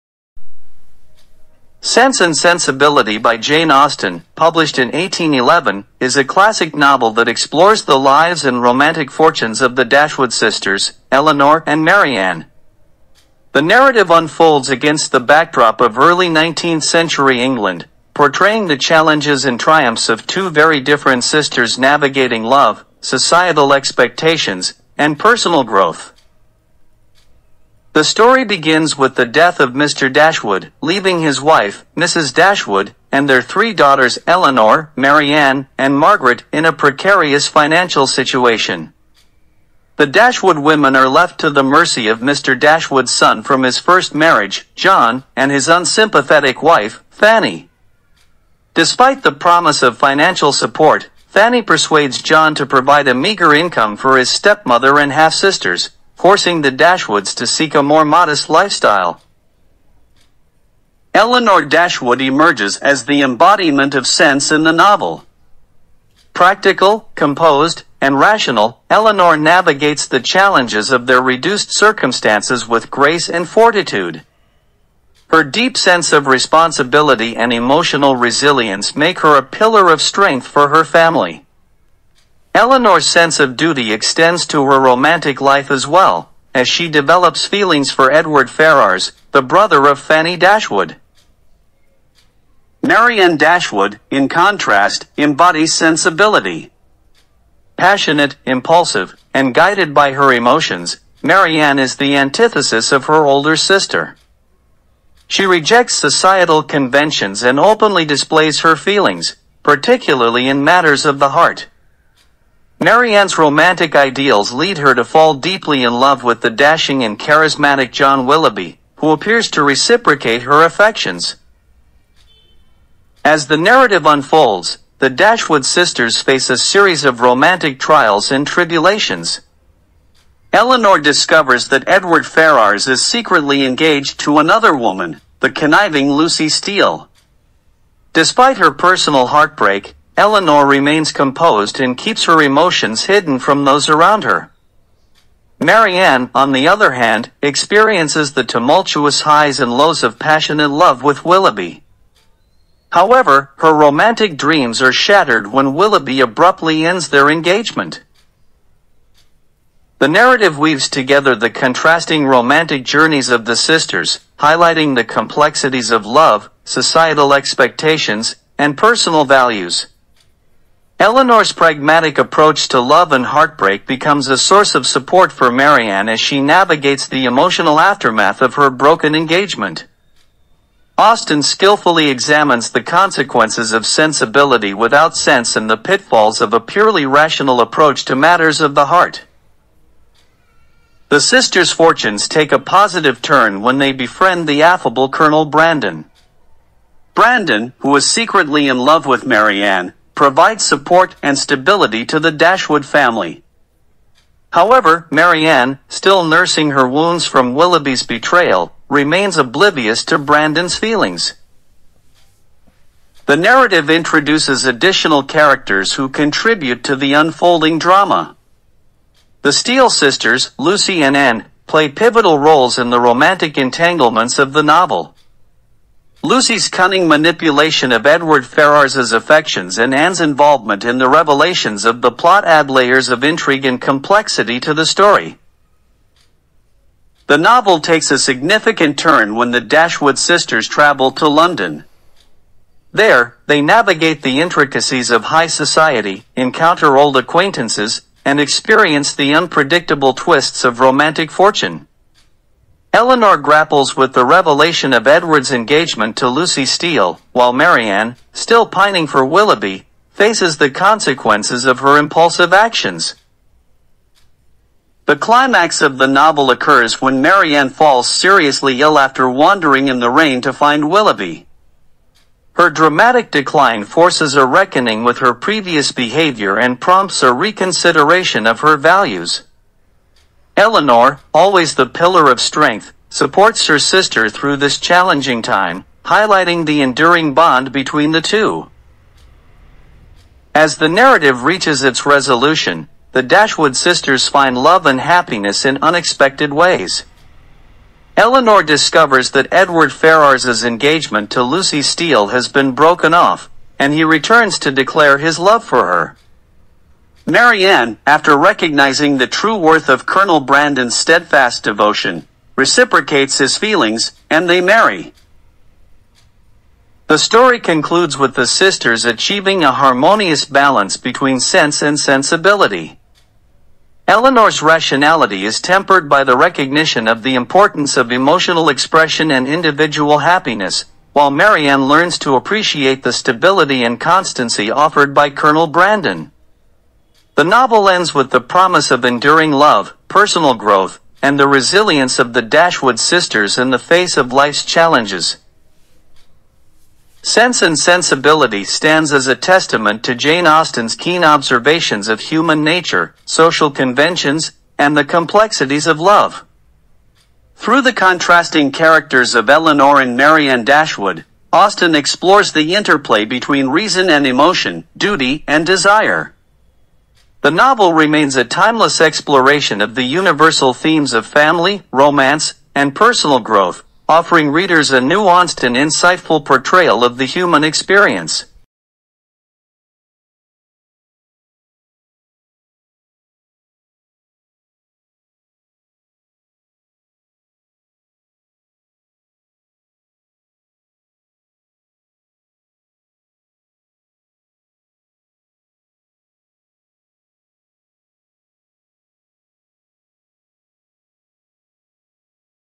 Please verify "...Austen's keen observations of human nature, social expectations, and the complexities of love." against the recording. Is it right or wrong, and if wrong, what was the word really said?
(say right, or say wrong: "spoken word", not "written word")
wrong: "conventions", not "expectations".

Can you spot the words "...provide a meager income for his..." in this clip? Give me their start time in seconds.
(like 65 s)
52 s.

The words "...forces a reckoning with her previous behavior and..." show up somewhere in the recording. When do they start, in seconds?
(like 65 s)
273 s.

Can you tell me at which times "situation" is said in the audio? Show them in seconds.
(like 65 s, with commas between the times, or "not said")
38 s.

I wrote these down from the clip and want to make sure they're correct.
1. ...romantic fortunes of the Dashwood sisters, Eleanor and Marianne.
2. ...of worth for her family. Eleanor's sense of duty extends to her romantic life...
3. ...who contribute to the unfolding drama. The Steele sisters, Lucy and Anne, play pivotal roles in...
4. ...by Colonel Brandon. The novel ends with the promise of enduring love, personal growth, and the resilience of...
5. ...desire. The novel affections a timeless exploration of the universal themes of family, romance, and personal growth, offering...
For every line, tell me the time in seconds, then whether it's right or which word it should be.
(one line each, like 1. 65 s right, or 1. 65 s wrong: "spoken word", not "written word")
1. 8 s right
2. 79 s wrong: "strength", not "worth"
3. 215 s right
4. 335 s right
5. 365 s wrong: "remains", not "affections".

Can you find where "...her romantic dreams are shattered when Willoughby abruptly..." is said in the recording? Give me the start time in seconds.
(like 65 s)
153 s.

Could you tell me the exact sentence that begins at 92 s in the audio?
Marianne Dashwood, in contrast, embodies sensibility.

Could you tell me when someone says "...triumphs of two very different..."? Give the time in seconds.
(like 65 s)
19 s.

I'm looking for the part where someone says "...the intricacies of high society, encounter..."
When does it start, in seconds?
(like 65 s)
244 s.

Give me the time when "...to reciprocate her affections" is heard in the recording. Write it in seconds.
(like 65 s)
119 s.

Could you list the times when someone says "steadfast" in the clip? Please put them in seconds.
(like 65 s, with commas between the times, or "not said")
310 s.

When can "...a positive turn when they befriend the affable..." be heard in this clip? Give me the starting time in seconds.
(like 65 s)
192 s.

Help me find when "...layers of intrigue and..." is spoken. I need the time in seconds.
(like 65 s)
232 s.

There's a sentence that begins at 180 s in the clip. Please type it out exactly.
Austen skillfully examines the consequences of sensibility without sense and the pitfalls of a purely rational approach to matters of the heart.